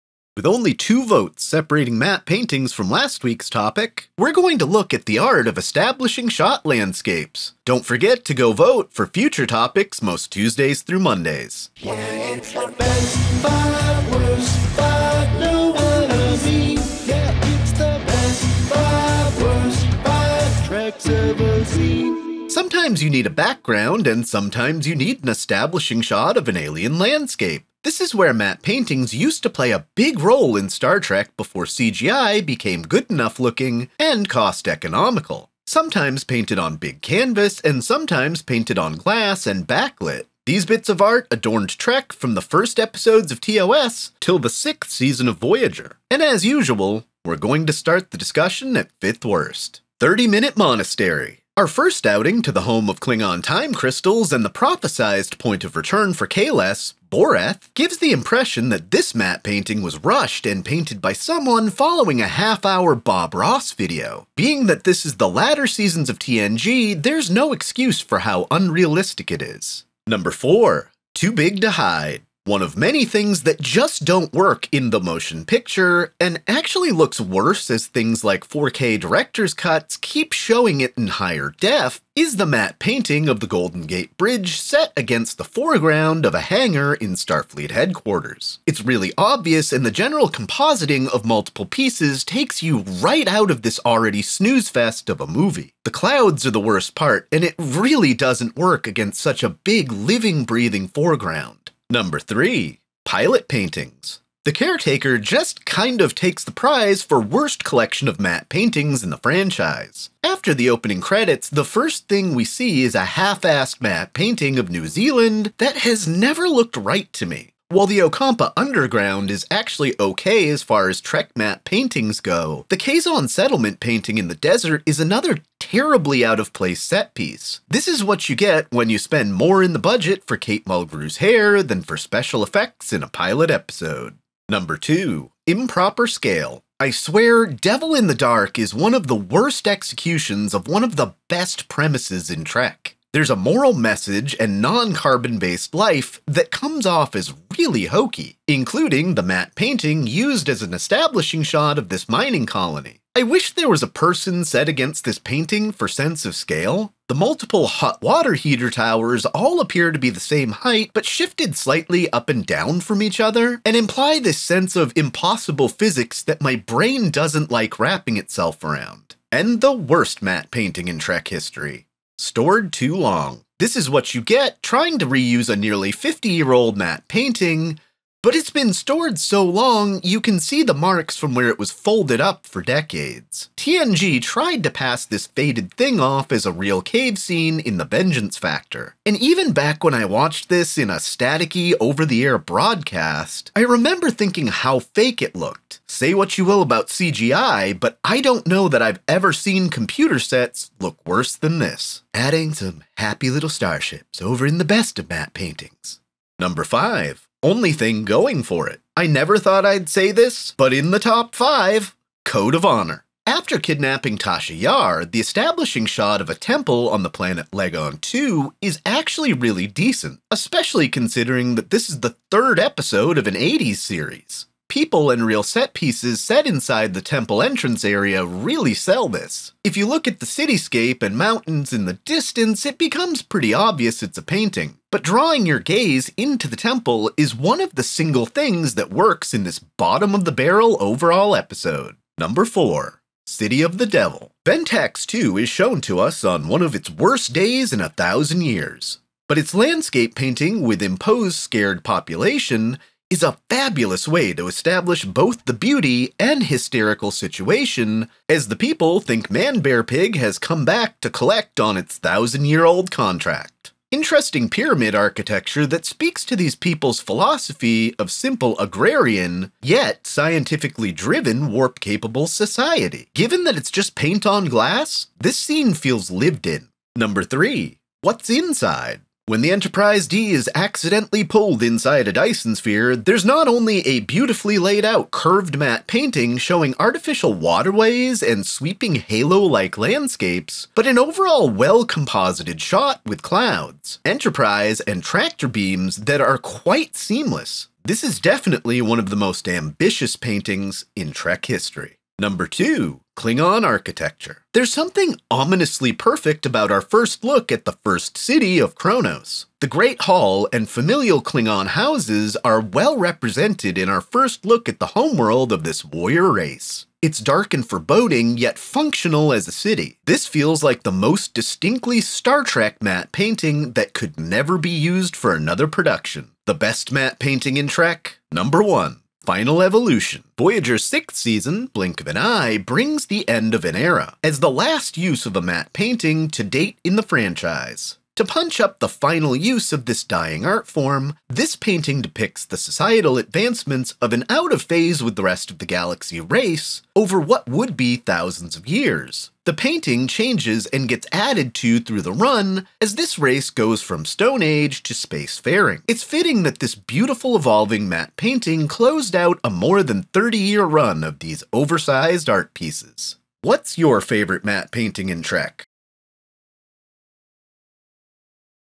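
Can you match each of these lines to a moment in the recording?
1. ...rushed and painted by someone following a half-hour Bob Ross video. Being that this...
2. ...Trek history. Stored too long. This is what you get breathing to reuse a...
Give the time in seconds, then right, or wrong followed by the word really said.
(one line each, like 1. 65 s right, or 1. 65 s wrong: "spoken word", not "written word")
1. 59 s right
2. 170 s wrong: "trying", not "breathing".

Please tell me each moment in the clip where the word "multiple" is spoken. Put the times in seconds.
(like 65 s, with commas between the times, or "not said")
91 s, 157 s.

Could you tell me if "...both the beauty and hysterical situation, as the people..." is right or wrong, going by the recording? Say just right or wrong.
right.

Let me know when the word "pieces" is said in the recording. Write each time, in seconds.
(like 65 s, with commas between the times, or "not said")
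91 s, 127 s, 225 s, 362 s.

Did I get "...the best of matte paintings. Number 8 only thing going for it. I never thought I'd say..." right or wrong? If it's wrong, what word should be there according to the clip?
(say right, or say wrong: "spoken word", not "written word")
wrong: "5", not "8".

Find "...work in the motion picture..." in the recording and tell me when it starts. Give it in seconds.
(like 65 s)
74 s.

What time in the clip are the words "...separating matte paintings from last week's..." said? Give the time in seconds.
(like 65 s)
1 s.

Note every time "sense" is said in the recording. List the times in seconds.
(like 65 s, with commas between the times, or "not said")
155 s, 164 s.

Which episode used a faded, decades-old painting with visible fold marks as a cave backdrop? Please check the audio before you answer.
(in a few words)
The Vengeance Factor.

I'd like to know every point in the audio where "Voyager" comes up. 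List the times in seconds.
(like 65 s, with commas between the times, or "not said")
45 s, 330 s.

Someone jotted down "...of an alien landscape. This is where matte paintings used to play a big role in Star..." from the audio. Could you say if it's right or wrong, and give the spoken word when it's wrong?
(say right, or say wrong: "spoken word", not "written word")
right.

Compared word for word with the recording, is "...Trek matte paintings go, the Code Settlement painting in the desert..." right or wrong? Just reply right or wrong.
wrong.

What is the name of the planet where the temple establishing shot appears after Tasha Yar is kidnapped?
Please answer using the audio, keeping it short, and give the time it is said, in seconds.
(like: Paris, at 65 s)
Ligon 2, at 217 s.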